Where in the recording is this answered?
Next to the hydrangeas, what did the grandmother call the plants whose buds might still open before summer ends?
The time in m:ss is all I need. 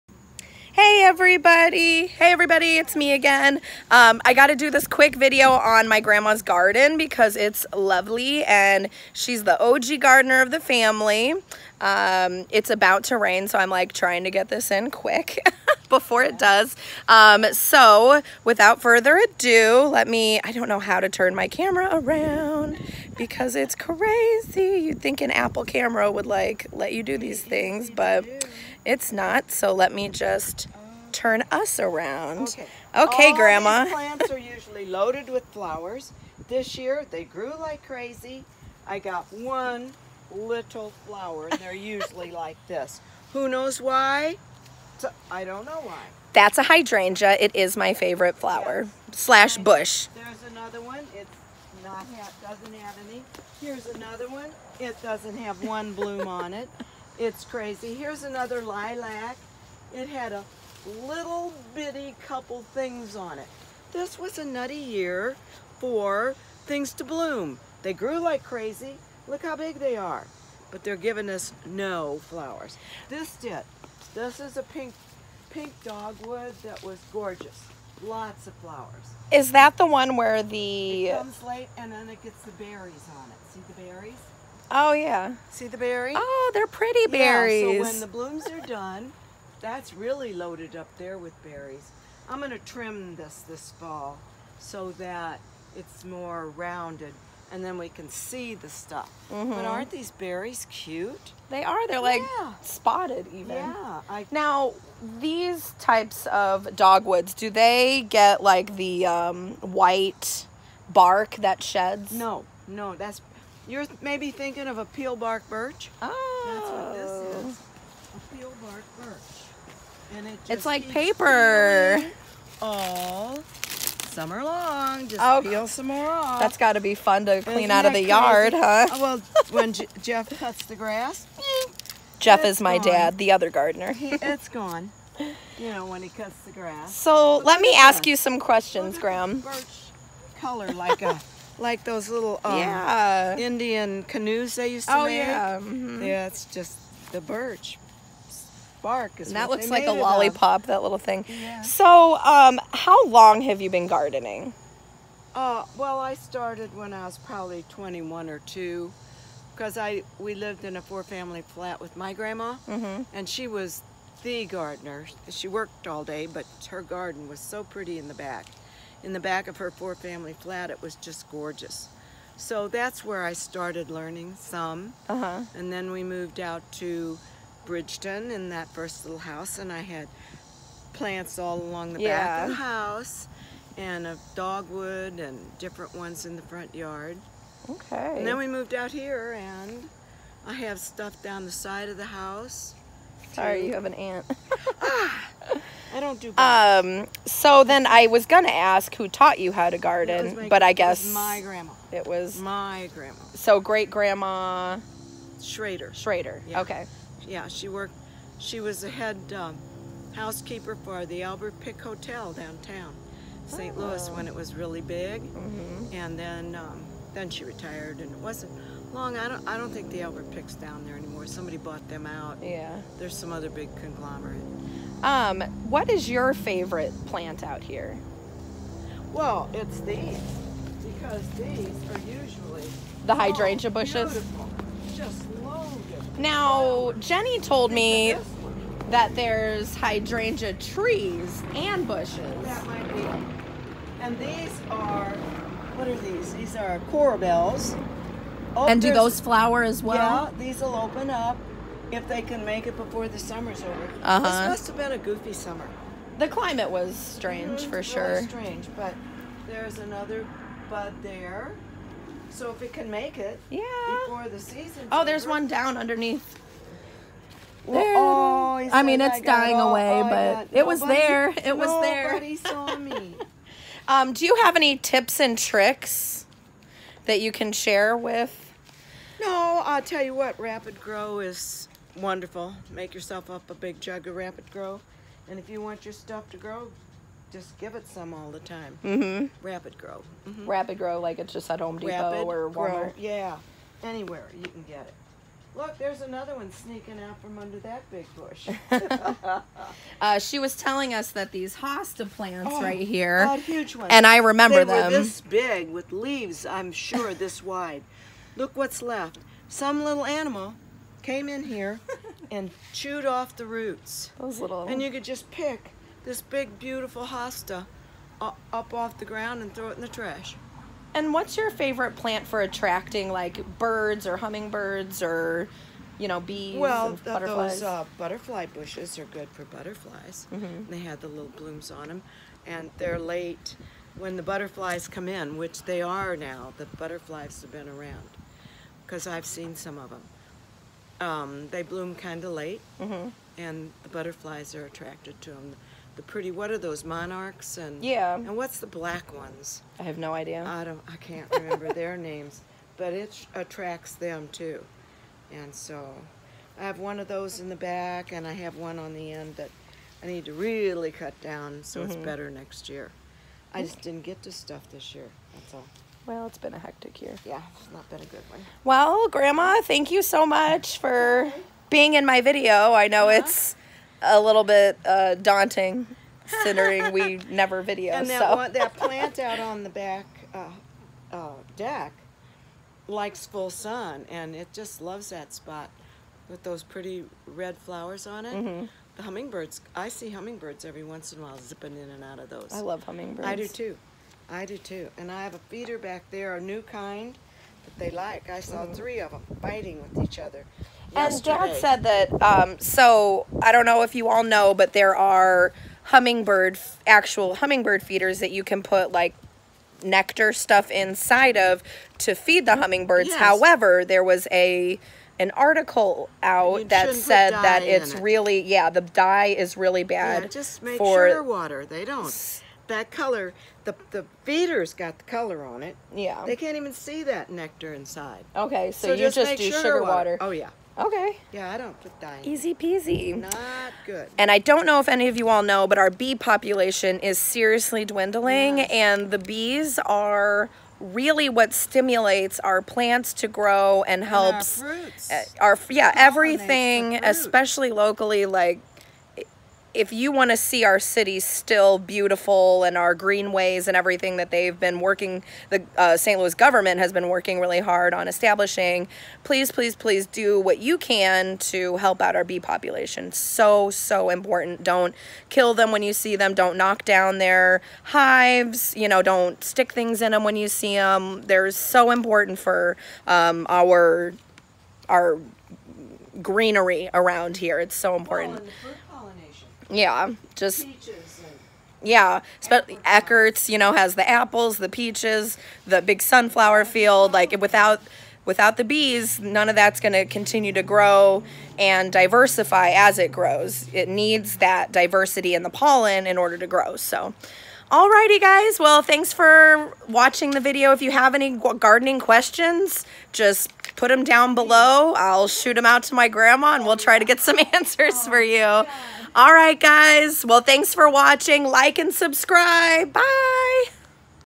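4:06.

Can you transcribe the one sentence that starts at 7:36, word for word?
Louis government has been working really hard on establishing, please, please, please do what you can to help out our bee population.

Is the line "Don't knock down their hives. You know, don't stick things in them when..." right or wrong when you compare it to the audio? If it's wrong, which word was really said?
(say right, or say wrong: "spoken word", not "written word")
right.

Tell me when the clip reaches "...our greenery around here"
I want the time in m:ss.
7:54.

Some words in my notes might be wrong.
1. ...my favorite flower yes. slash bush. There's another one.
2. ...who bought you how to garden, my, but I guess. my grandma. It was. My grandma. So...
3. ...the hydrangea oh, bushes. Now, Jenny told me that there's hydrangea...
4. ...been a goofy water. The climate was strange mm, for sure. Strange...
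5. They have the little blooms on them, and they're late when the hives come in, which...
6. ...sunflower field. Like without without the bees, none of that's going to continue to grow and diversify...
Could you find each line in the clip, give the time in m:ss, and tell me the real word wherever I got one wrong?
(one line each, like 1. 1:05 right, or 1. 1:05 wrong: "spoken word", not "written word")
1. 0:47 right
2. 3:18 wrong: "taught", not "bought"
3. 3:53 right
4. 4:14 wrong: "summer", not "water"
5. 5:30 wrong: "butterflies", not "hives"
6. 8:06 right.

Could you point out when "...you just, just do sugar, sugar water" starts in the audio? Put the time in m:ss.
7:08.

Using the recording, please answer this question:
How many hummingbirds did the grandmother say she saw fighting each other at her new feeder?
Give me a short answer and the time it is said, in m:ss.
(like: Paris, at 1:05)
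3, at 6:38.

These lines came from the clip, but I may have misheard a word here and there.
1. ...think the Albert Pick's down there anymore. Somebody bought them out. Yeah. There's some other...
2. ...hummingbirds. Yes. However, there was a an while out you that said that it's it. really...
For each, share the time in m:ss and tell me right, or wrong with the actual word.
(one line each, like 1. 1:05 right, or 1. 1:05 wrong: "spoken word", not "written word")
1. 3:39 right
2. 6:52 wrong: "article", not "while".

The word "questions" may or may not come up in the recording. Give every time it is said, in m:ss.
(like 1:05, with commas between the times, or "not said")
2:18, 8:22.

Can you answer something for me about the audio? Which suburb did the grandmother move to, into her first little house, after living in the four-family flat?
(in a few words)
Bridgeton.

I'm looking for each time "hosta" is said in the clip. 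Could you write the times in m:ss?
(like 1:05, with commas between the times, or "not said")
5:01, 5:17.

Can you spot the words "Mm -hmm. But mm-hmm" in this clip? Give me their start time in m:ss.
1:39.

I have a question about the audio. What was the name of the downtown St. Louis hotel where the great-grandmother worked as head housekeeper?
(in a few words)
Albert Pick Hotel.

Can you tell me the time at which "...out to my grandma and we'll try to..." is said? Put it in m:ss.
8:25.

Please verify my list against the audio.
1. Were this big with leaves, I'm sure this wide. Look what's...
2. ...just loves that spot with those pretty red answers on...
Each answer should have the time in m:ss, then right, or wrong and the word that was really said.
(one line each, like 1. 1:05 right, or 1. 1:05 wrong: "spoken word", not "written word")
1. 5:04 right
2. 6:24 wrong: "flowers", not "answers".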